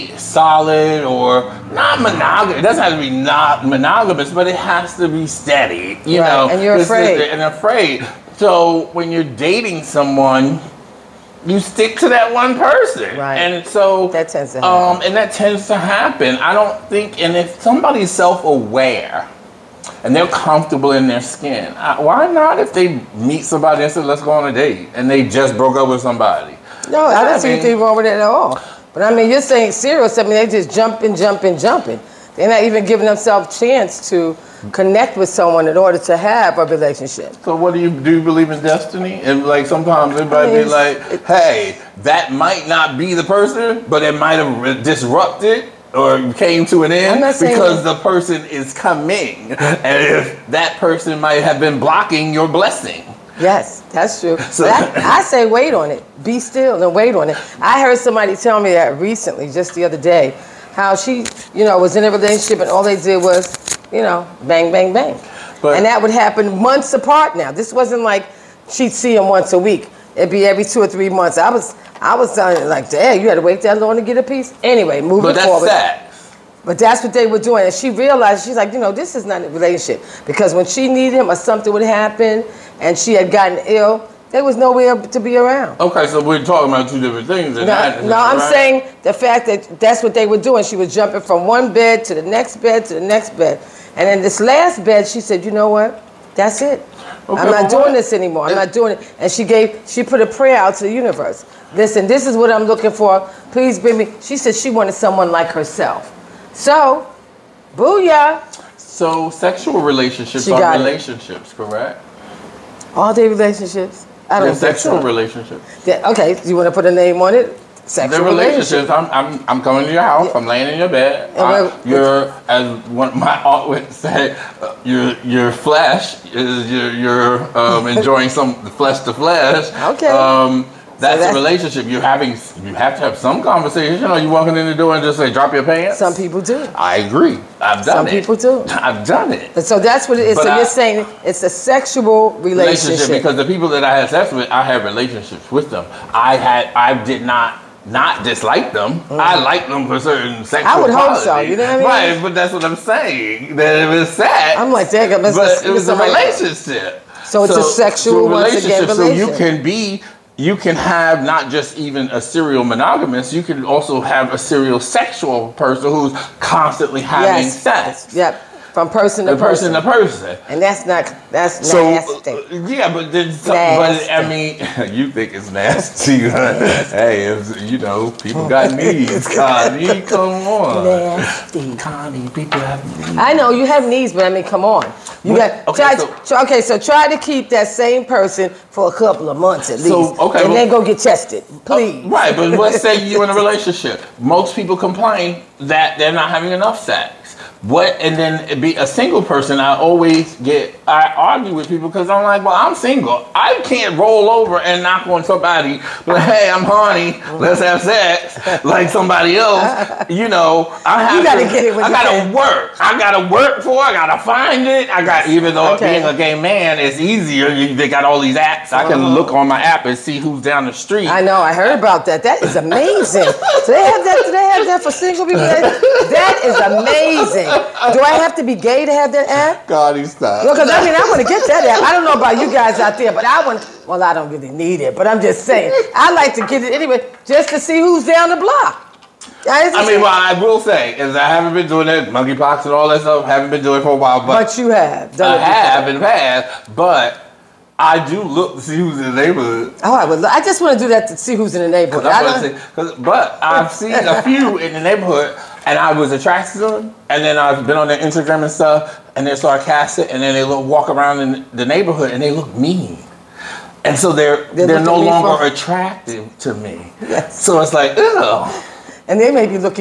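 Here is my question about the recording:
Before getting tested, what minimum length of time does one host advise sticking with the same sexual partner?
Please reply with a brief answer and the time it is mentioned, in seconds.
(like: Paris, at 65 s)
A couple of months, at 188 s.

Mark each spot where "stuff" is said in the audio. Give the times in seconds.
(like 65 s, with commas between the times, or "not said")
243 s, 258 s.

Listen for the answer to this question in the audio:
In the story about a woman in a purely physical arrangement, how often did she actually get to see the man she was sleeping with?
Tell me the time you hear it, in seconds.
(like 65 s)
70 s.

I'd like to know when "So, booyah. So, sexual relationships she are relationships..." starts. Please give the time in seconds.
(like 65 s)
106 s.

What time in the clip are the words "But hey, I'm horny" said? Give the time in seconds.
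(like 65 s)
206 s.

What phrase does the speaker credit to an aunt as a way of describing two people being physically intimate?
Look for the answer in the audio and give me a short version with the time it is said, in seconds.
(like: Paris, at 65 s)
Flesh to flesh, at 128 s.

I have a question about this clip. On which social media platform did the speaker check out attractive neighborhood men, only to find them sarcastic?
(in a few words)
Instagram.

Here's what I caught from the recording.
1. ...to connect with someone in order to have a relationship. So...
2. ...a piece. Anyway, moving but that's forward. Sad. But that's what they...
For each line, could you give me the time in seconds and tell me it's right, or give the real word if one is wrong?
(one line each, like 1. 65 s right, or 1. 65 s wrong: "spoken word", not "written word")
1. 34 s right
2. 74 s right.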